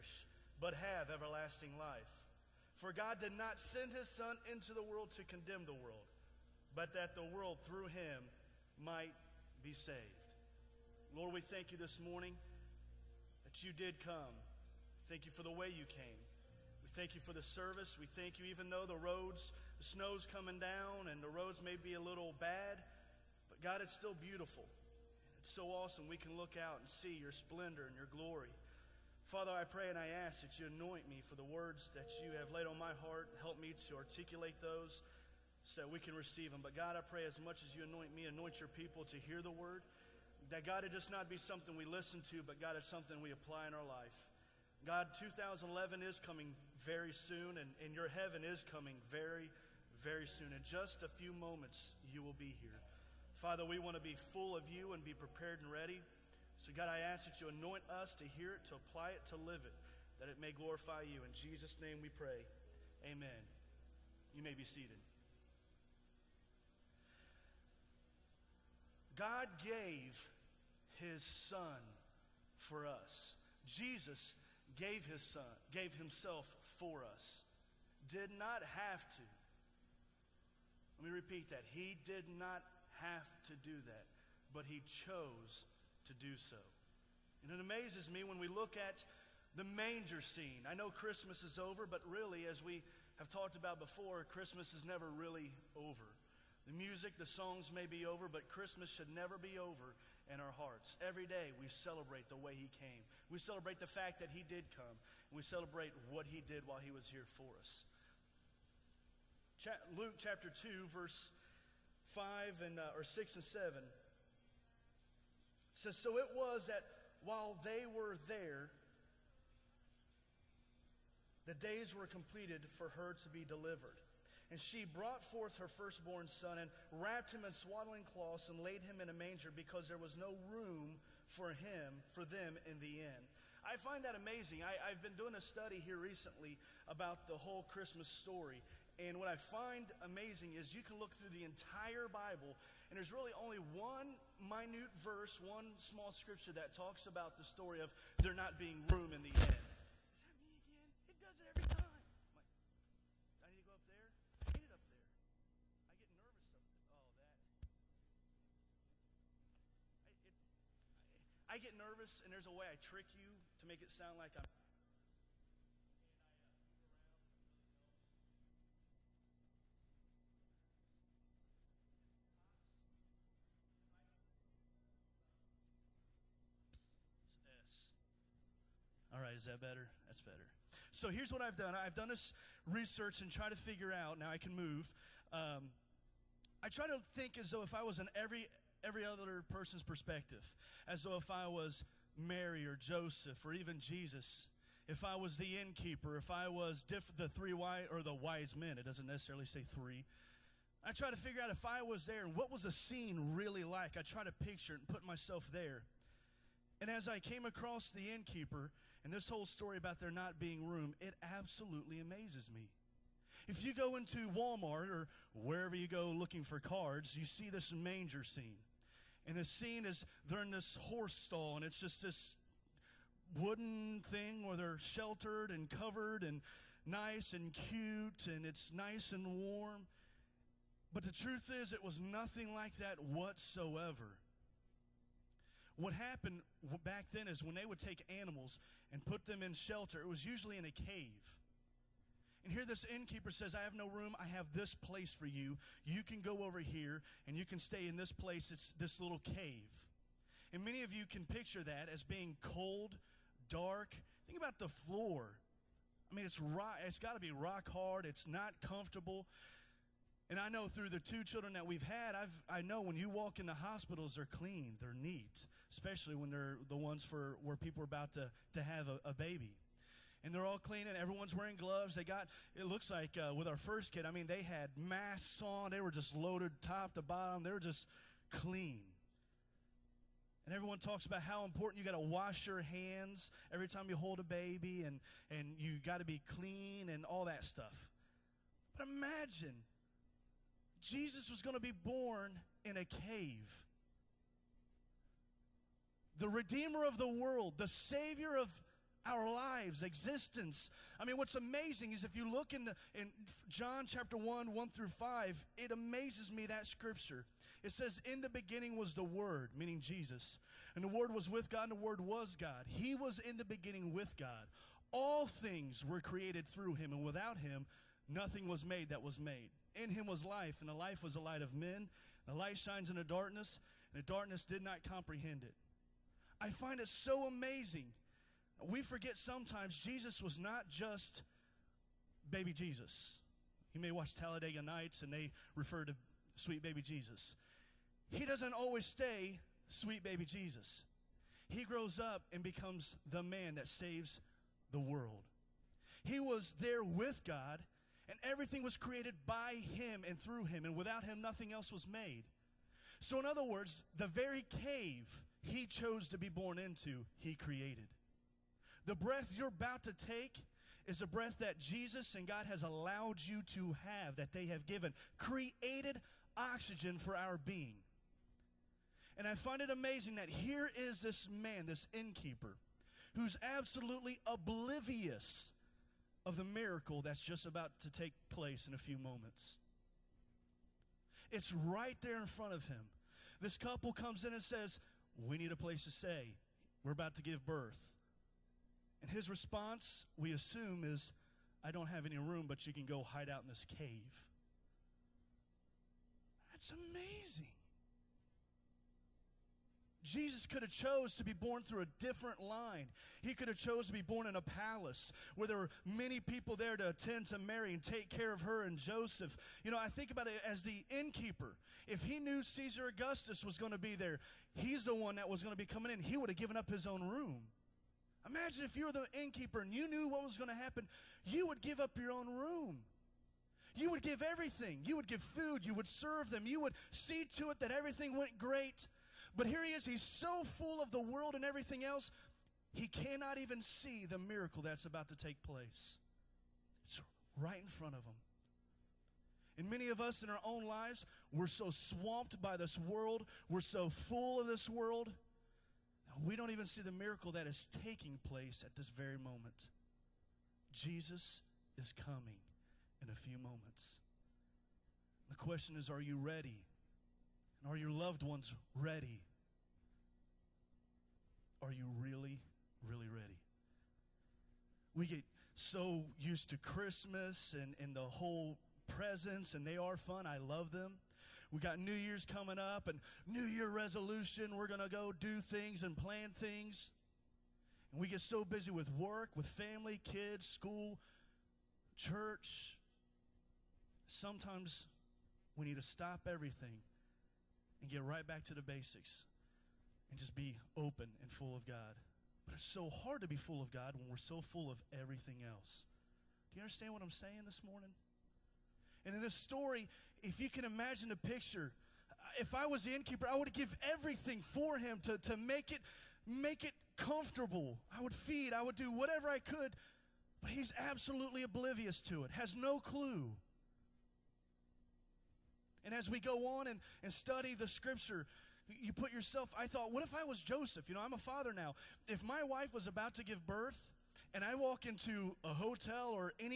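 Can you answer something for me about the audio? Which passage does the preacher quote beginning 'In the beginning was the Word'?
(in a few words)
John 1:1-5.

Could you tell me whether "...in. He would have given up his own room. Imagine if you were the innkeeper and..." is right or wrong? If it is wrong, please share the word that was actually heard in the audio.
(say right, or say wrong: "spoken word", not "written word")
right.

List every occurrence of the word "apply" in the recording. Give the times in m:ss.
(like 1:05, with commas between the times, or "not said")
0:43, 0:58.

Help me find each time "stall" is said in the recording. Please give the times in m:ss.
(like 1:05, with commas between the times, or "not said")
3:41.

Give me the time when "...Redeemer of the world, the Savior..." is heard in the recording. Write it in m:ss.
4:56.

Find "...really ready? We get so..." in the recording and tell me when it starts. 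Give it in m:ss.
7:42.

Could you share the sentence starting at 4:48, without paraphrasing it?
But imagine Jesus was going to be born in a cave.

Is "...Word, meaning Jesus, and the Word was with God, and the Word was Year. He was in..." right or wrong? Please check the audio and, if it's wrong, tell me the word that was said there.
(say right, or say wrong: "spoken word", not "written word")
wrong: "God", not "Year".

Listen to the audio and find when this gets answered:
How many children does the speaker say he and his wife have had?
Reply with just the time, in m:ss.
4:20.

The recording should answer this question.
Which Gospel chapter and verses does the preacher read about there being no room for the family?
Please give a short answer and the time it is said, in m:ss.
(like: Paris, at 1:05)
Luke 2:6-7, at 1:49.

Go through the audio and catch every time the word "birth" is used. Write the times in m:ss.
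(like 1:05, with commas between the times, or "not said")
6:27, 8:43.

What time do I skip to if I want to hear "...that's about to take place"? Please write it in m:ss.
7:14.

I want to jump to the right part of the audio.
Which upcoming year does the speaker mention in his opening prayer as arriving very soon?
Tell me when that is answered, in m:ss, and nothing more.
0:45.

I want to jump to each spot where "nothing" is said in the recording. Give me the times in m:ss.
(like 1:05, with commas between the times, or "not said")
3:51, 5:18, 5:51.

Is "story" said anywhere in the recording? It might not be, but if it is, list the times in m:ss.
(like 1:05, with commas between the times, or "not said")
2:18, 2:27, 3:29, 8:19.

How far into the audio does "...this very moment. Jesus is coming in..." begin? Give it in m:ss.
7:28.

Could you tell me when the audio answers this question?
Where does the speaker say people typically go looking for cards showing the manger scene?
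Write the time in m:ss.
3:34.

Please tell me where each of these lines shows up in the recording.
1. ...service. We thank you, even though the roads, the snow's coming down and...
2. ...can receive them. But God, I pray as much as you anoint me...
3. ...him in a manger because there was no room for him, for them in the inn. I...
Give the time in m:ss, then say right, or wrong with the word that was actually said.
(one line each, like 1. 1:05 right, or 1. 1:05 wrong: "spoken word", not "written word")
1. 0:17 right
2. 0:36 right
3. 2:08 right.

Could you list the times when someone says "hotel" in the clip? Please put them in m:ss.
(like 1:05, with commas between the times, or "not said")
8:45.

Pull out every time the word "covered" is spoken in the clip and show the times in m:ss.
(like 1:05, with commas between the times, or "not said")
3:45.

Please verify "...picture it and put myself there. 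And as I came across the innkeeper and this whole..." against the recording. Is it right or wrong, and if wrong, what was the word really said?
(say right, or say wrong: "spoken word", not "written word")
right.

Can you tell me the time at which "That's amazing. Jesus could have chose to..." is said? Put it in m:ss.
6:36.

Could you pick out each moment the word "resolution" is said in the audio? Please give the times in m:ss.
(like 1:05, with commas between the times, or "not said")
7:53.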